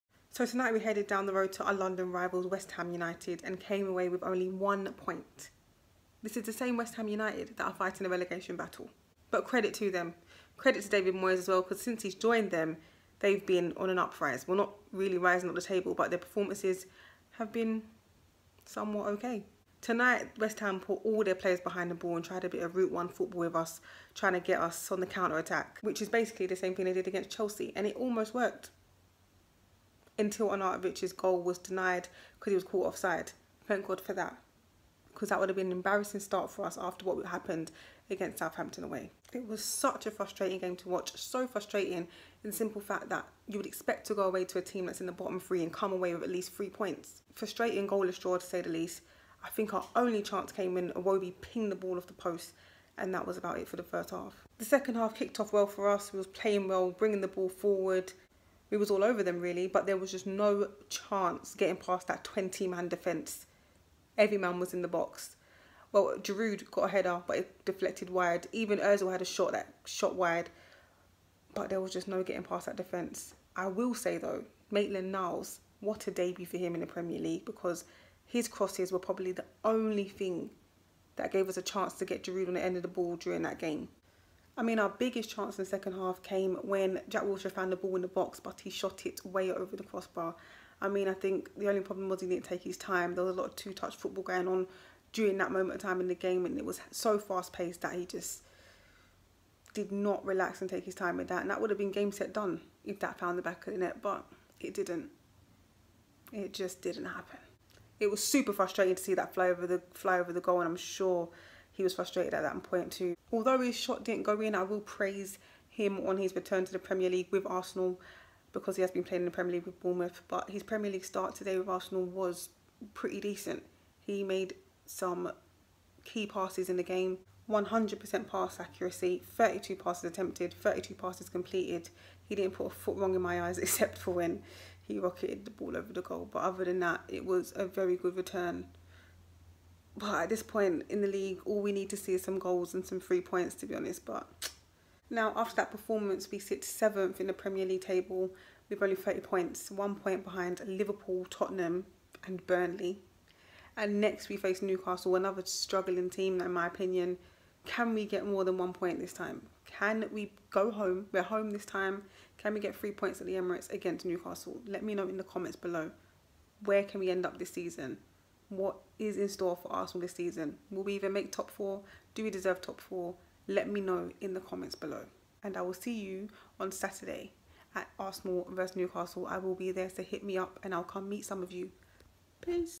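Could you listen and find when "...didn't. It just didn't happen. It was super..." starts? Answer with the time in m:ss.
1:44.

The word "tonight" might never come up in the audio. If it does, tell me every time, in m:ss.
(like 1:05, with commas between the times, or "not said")
0:00, 0:19.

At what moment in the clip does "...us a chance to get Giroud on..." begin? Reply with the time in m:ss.
1:21.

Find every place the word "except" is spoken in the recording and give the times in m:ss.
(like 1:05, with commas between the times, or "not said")
2:13.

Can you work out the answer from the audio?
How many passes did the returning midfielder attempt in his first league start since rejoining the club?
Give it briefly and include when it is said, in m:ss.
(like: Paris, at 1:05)
32, at 2:09.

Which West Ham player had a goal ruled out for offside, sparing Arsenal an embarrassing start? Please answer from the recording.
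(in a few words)
Arnautovic.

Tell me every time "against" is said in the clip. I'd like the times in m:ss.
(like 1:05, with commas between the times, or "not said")
0:27, 0:38, 2:43.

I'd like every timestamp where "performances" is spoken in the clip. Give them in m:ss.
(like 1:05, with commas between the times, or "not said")
0:16, 2:25.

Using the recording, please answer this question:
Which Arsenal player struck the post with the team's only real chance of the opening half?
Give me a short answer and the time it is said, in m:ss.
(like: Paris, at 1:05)
Iwobi, at 0:50.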